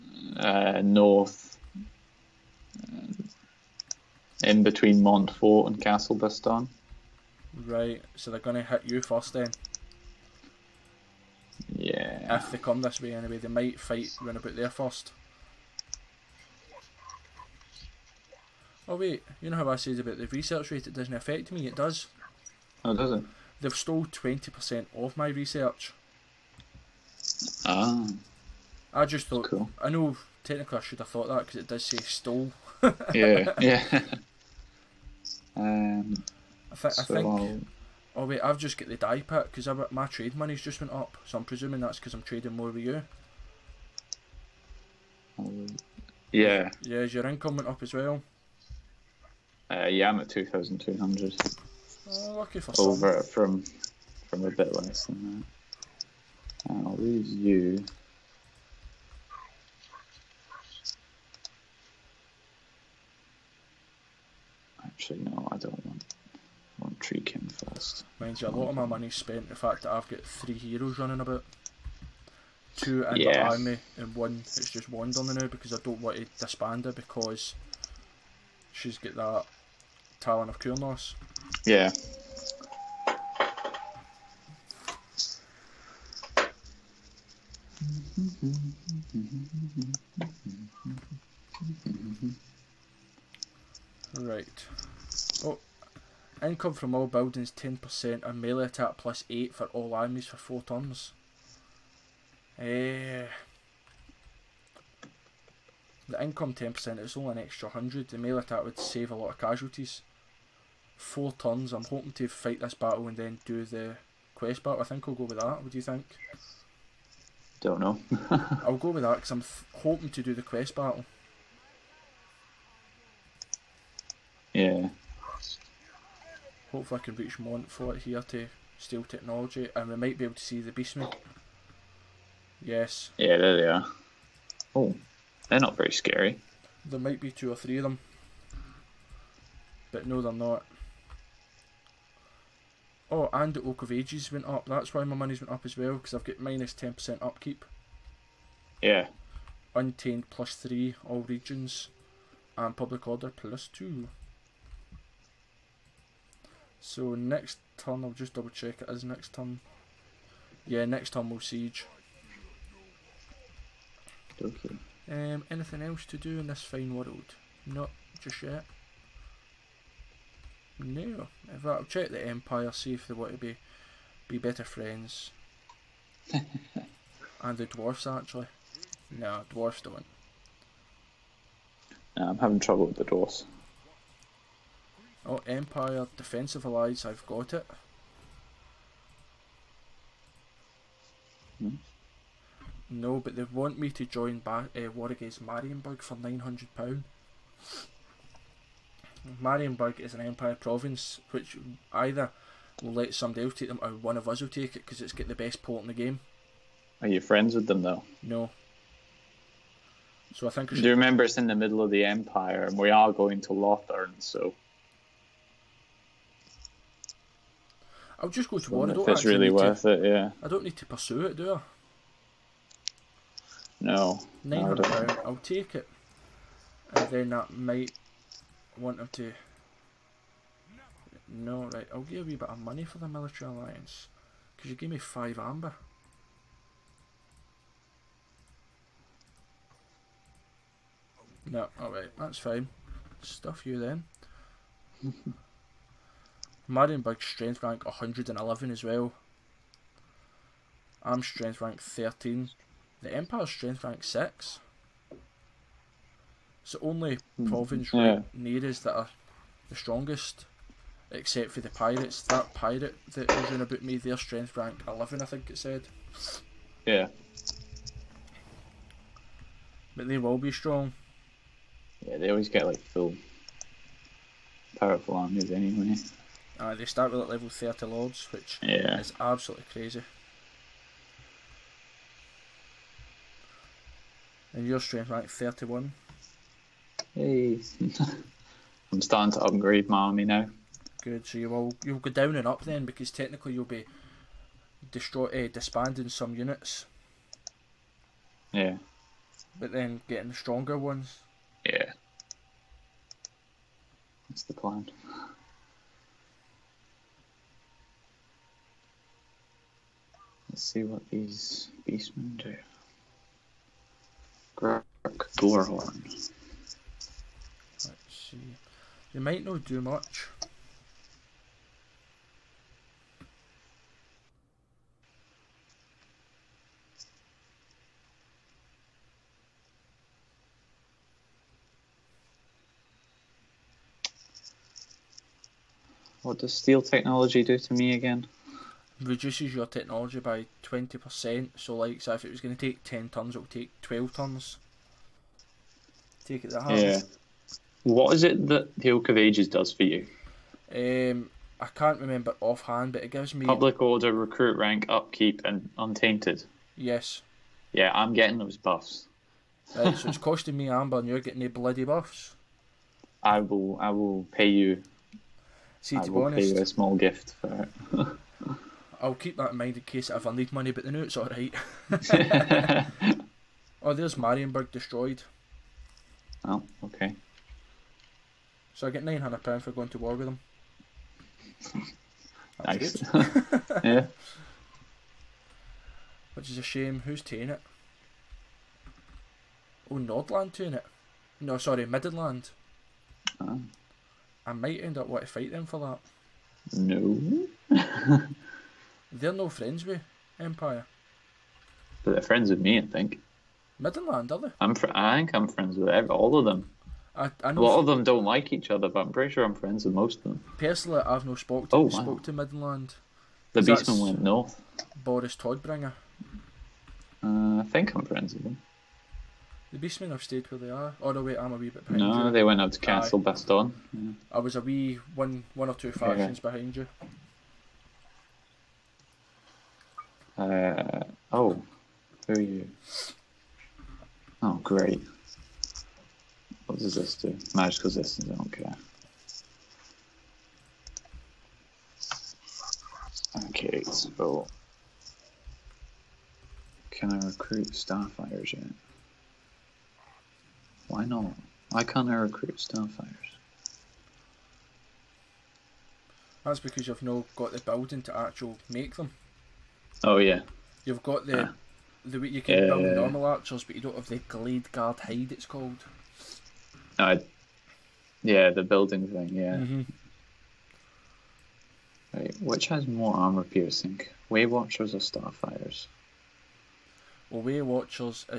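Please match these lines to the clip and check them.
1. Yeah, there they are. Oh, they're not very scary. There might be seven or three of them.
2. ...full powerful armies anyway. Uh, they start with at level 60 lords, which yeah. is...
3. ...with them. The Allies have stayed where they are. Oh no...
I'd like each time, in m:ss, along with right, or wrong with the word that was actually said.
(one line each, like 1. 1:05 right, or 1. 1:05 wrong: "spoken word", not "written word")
1. 2:13 wrong: "two", not "seven"
2. 4:32 wrong: "30", not "60"
3. 6:58 wrong: "Beastmen", not "Allies".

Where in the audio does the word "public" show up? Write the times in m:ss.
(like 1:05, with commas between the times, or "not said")
2:32, 5:53.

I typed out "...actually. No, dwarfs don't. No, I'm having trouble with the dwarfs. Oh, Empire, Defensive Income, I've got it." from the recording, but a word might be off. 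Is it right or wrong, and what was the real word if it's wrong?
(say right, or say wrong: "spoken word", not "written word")
wrong: "Allies", not "Income".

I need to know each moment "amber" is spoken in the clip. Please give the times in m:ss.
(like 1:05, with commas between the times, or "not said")
3:55, 6:00.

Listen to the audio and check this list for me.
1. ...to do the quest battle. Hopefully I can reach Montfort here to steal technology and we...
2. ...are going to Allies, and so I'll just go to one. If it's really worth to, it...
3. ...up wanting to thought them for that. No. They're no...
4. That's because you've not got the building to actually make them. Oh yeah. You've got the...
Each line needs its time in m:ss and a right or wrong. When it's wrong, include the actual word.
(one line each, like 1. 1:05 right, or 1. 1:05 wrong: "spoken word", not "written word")
1. 2:00 right
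2. 3:32 wrong: "Lothar", not "Allies"
3. 6:34 wrong: "fight", not "thought"
4. 7:36 right.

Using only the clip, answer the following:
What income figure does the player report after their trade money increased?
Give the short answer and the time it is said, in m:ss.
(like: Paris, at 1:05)
2,200, at 0:50.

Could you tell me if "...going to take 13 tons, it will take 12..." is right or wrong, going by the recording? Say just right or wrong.
wrong.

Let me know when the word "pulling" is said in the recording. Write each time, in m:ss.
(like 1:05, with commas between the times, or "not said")
not said.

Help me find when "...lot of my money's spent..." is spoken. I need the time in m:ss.
1:08.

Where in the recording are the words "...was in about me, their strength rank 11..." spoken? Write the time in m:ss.
4:23.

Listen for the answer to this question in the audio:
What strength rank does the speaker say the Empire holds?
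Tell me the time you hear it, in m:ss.
4:13.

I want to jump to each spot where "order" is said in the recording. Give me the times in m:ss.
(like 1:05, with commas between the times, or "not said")
2:33, 5:53.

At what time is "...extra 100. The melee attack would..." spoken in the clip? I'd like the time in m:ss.
1:47.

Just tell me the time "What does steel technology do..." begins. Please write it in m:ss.
5:36.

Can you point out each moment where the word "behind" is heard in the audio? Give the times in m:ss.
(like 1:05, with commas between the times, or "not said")
7:01, 7:06.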